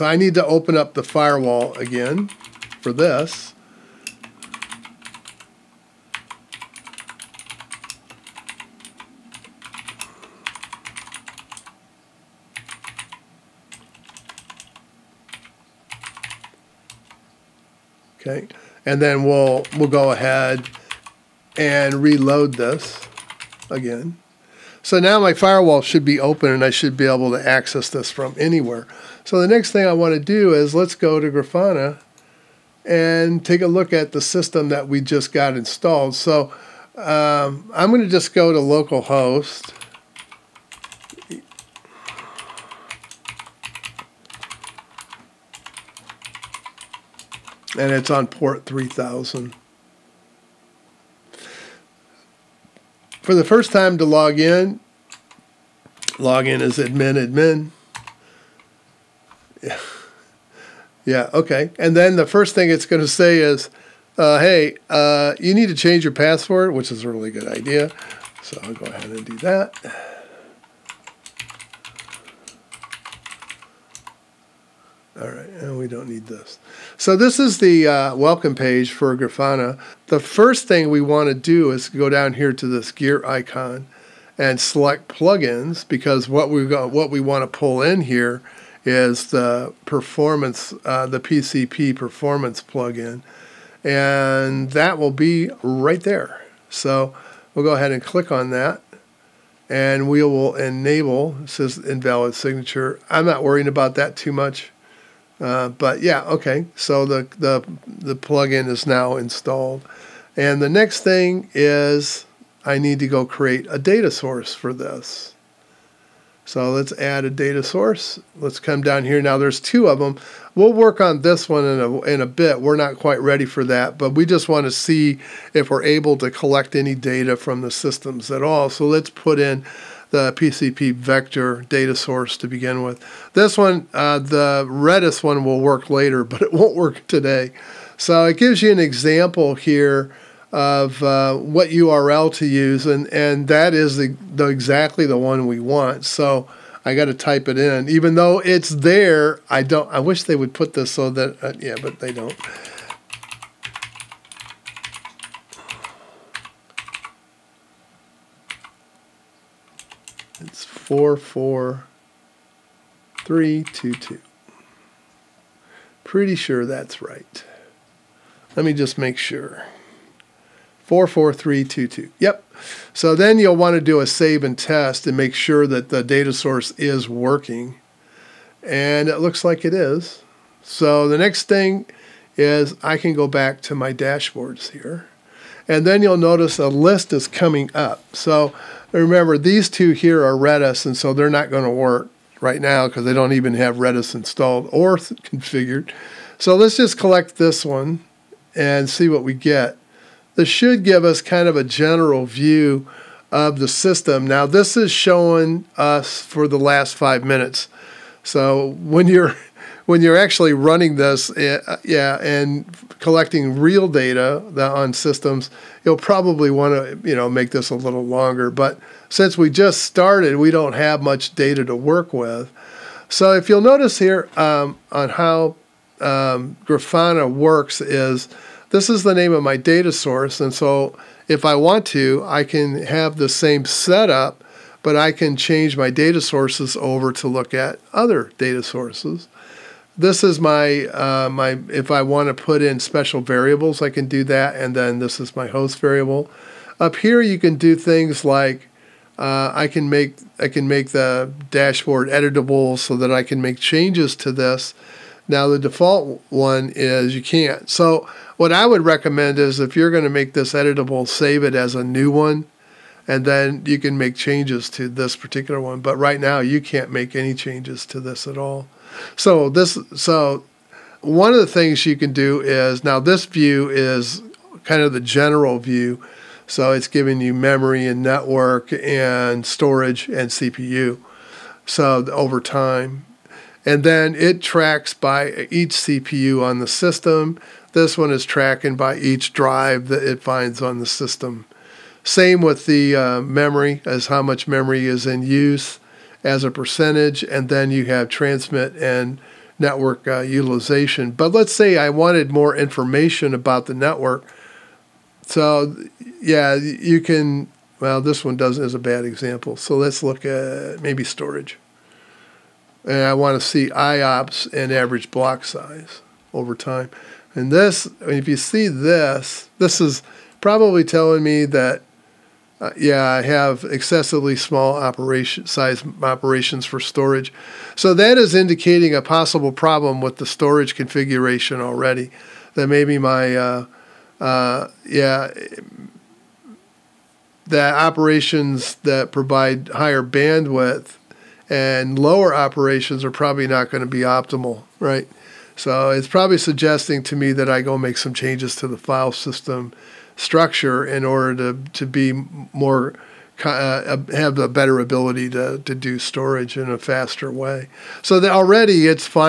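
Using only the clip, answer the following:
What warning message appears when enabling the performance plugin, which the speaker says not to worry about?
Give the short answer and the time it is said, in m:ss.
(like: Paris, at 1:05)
invalid signature, at 1:41.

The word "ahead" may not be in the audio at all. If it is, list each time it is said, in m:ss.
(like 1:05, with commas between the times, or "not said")
0:20, 1:08, 1:37.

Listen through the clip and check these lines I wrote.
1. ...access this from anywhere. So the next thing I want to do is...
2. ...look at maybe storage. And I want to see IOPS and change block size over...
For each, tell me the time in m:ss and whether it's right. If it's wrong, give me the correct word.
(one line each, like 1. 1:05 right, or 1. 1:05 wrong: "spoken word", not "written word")
1. 0:27 right
2. 5:10 wrong: "average", not "change".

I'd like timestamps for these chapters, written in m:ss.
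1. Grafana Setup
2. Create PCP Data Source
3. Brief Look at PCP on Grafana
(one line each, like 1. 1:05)
1. 0:31
2. 1:54
3. 3:01.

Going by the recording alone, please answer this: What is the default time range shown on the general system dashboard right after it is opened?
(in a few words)
last five minutes.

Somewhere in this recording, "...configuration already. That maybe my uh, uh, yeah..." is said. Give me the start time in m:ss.
5:30.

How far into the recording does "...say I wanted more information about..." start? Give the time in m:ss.
5:01.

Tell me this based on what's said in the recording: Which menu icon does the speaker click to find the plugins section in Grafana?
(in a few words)
gear icon.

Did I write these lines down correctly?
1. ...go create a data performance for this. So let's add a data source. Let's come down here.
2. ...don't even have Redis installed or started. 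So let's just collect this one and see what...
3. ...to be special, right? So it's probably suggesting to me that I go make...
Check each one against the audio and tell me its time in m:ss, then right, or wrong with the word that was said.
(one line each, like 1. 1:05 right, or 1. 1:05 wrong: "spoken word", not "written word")
1. 1:53 wrong: "source", not "performance"
2. 3:13 wrong: "configured", not "started"
3. 5:43 wrong: "optimal", not "special".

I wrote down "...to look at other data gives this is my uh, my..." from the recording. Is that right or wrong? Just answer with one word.
wrong.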